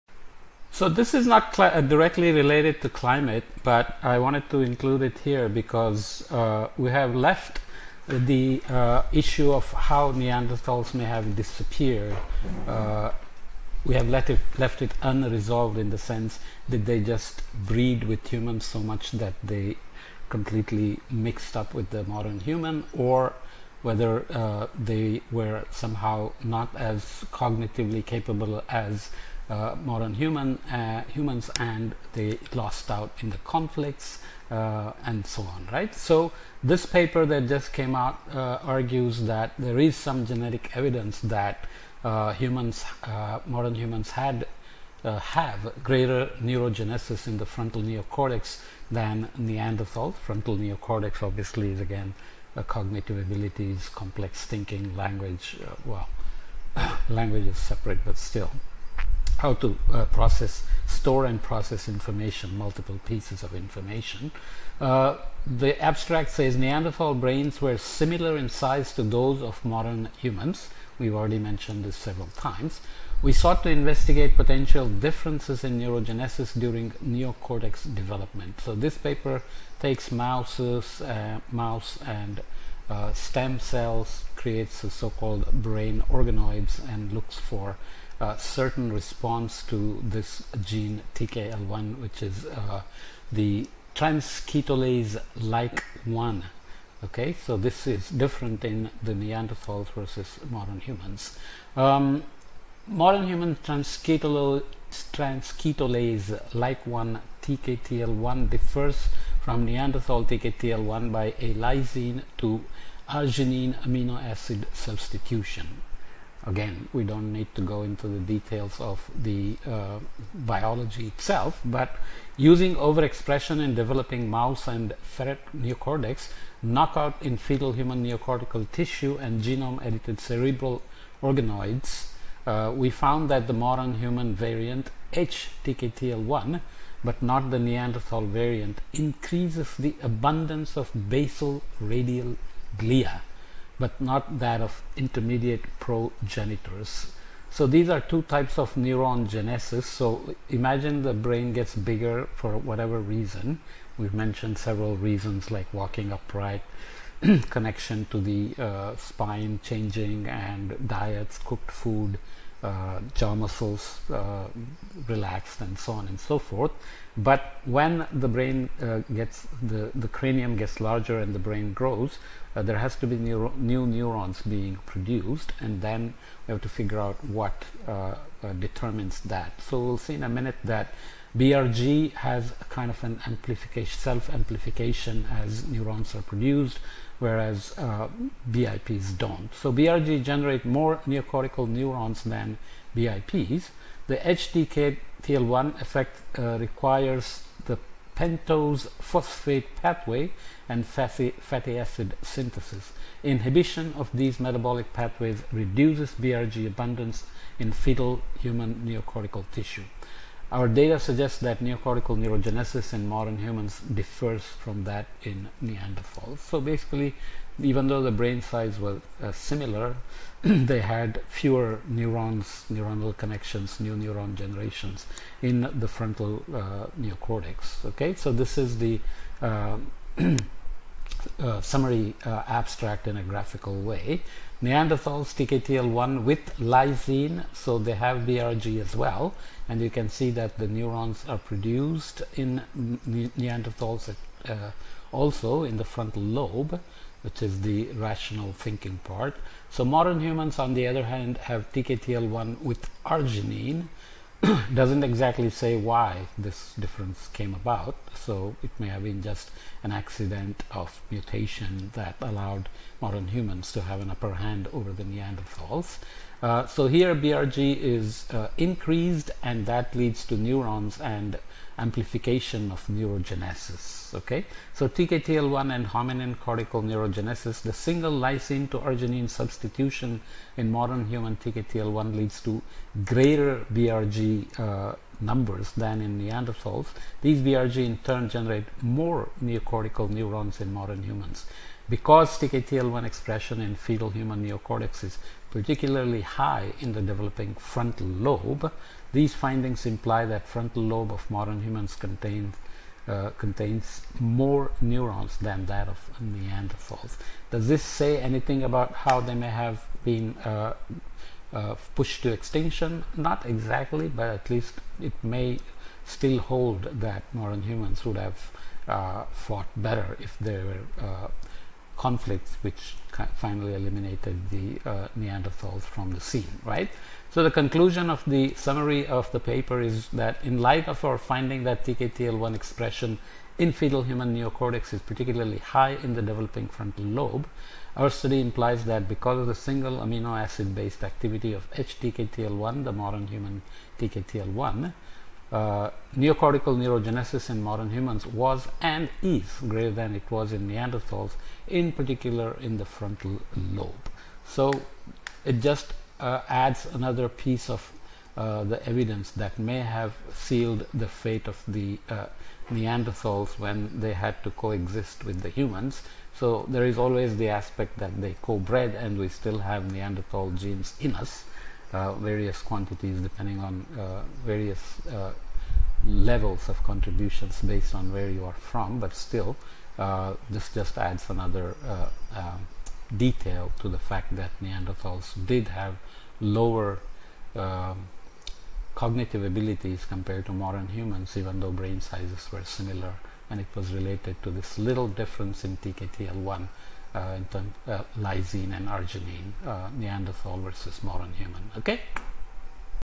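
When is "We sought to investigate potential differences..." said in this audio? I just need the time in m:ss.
1:13.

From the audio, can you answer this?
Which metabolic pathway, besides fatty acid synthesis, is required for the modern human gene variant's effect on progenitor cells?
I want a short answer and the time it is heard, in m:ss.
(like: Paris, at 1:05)
pentose phosphate pathway, at 3:18.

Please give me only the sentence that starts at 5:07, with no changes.
Does this say anything about how they may have been uh, uh, pushed to extinction?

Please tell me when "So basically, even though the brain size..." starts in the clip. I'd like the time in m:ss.
3:36.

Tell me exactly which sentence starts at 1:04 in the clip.
Uh, the abstract says Neanderthal brains were similar in size to those of modern humans.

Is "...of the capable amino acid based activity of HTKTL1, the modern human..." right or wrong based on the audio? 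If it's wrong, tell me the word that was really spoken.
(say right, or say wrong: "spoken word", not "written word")
wrong: "single", not "capable".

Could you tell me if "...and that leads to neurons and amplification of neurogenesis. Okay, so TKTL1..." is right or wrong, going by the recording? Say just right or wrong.
right.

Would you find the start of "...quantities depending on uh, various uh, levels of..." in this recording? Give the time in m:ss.
6:12.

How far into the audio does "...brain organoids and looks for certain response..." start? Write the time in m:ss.
1:25.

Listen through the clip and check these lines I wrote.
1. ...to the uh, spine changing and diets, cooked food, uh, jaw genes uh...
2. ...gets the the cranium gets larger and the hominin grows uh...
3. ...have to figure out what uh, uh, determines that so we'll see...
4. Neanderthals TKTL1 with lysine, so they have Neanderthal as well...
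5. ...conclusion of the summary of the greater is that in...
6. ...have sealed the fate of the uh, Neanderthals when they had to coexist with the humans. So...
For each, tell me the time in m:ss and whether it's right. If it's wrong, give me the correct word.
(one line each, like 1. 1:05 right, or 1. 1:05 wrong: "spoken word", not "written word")
1. 2:38 wrong: "muscles", not "genes"
2. 2:49 wrong: "brain", not "hominin"
3. 2:56 right
4. 3:54 wrong: "BRG", not "Neanderthal"
5. 5:27 wrong: "paper", not "greater"
6. 5:59 right.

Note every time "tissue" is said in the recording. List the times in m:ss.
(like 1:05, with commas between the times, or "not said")
2:08, 3:29.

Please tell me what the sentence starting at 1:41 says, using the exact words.
Um, modern human transketolase, transketolase like one TKTL1 differs from Neanderthal TKTL1 by a lysine to arginine amino acid substitution.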